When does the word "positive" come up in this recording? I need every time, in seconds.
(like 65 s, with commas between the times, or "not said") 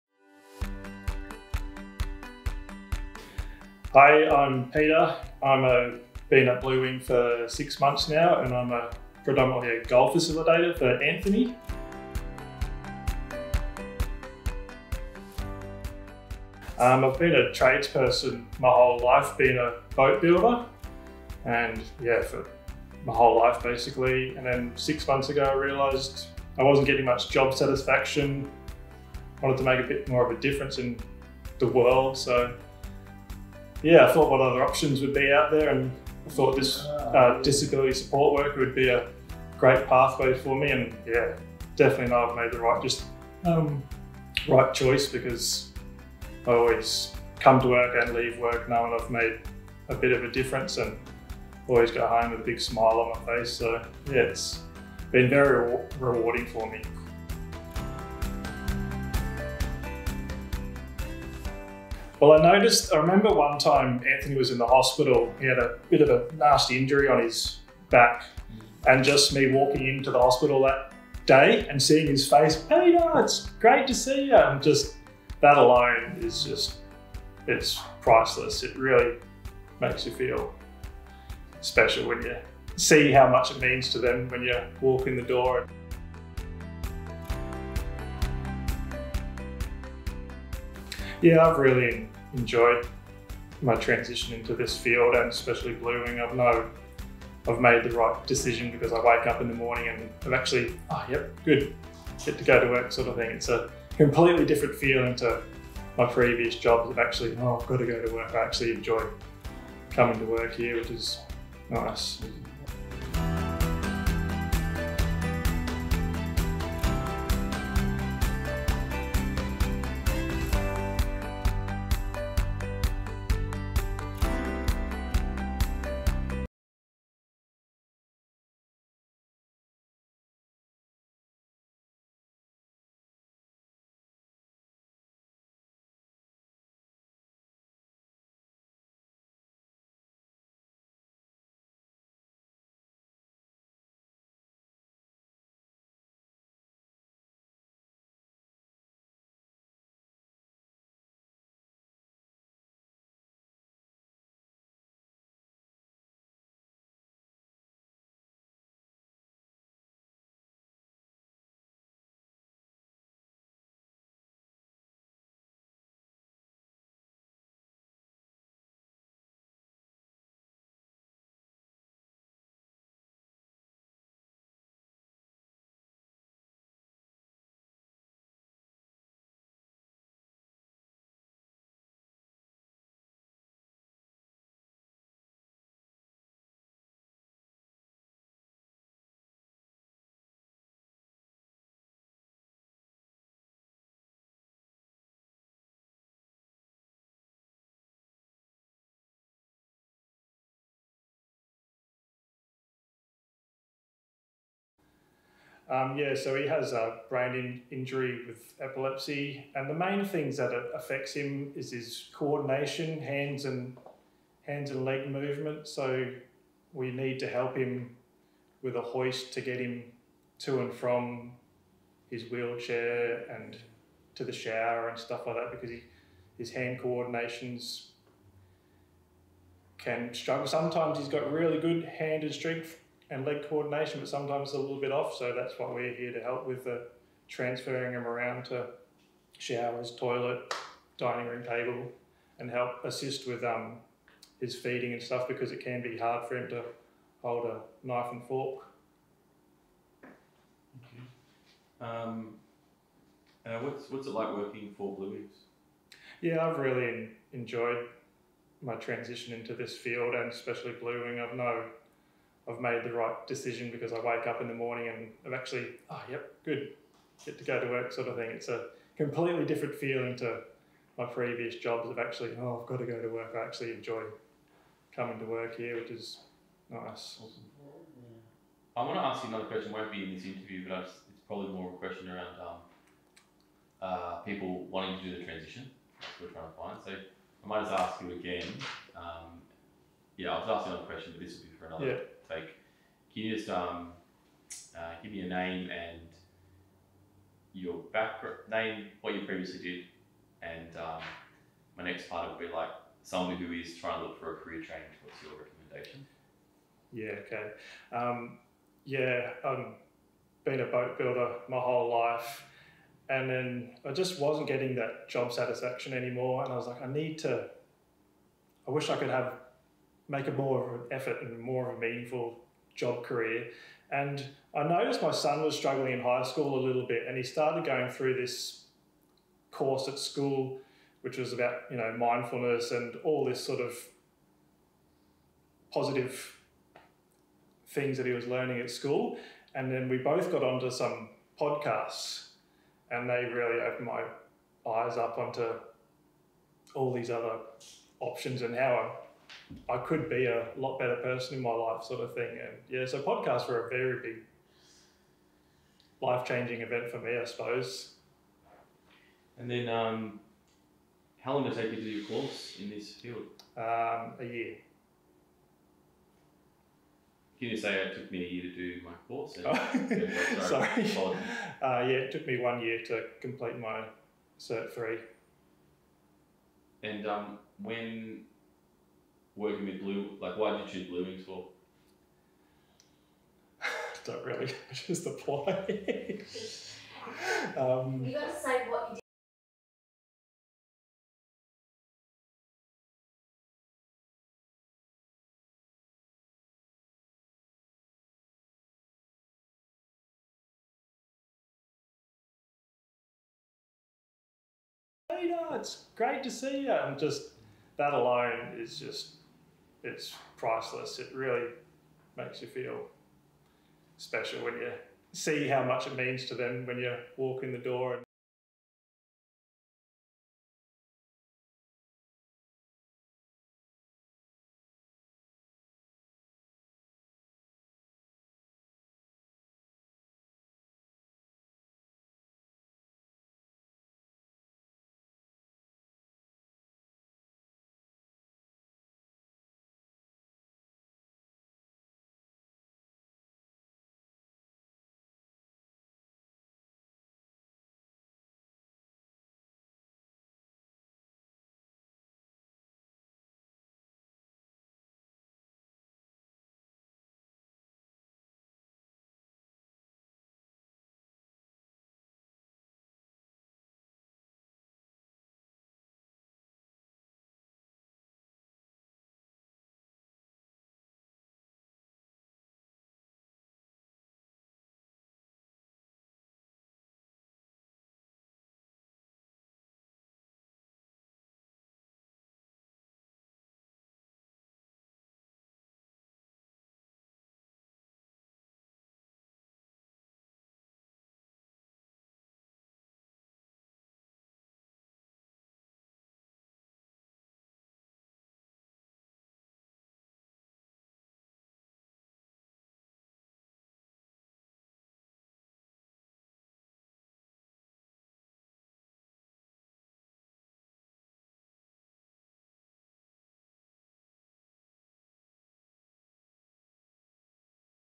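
335 s.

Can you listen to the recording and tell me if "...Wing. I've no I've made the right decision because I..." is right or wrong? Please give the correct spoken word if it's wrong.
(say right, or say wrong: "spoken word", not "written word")
right.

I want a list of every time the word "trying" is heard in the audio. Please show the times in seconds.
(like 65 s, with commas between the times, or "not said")
286 s, 303 s.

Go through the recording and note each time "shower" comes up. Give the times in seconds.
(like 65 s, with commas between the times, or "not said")
224 s, 239 s.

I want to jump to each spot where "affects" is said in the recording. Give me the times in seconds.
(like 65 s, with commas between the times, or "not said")
210 s.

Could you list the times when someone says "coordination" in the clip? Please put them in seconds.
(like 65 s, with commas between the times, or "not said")
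212 s, 226 s, 233 s.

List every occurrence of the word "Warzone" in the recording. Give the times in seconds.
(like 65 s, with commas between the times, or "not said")
not said.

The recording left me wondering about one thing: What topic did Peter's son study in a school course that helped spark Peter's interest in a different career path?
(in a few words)
Mindfulness.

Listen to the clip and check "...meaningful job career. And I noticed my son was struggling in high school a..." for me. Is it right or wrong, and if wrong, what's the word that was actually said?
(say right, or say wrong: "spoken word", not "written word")
right.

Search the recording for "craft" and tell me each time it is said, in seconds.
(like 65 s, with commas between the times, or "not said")
not said.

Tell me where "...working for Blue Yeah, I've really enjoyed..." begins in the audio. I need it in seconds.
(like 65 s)
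254 s.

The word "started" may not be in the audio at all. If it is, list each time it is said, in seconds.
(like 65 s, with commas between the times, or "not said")
327 s.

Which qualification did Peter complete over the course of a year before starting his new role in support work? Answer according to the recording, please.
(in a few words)
Cert 3.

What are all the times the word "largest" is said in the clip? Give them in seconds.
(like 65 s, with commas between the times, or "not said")
not said.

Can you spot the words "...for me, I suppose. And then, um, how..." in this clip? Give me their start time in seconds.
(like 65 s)
356 s.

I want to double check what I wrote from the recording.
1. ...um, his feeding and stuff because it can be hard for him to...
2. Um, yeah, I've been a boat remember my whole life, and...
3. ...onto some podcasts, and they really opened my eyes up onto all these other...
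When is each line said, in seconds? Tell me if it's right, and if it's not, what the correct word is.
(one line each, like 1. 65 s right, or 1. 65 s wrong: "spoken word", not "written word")
1. 243 s right
2. 307 s wrong: "builder", not "remember"
3. 340 s right.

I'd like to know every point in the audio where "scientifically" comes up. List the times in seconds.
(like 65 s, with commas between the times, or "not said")
not said.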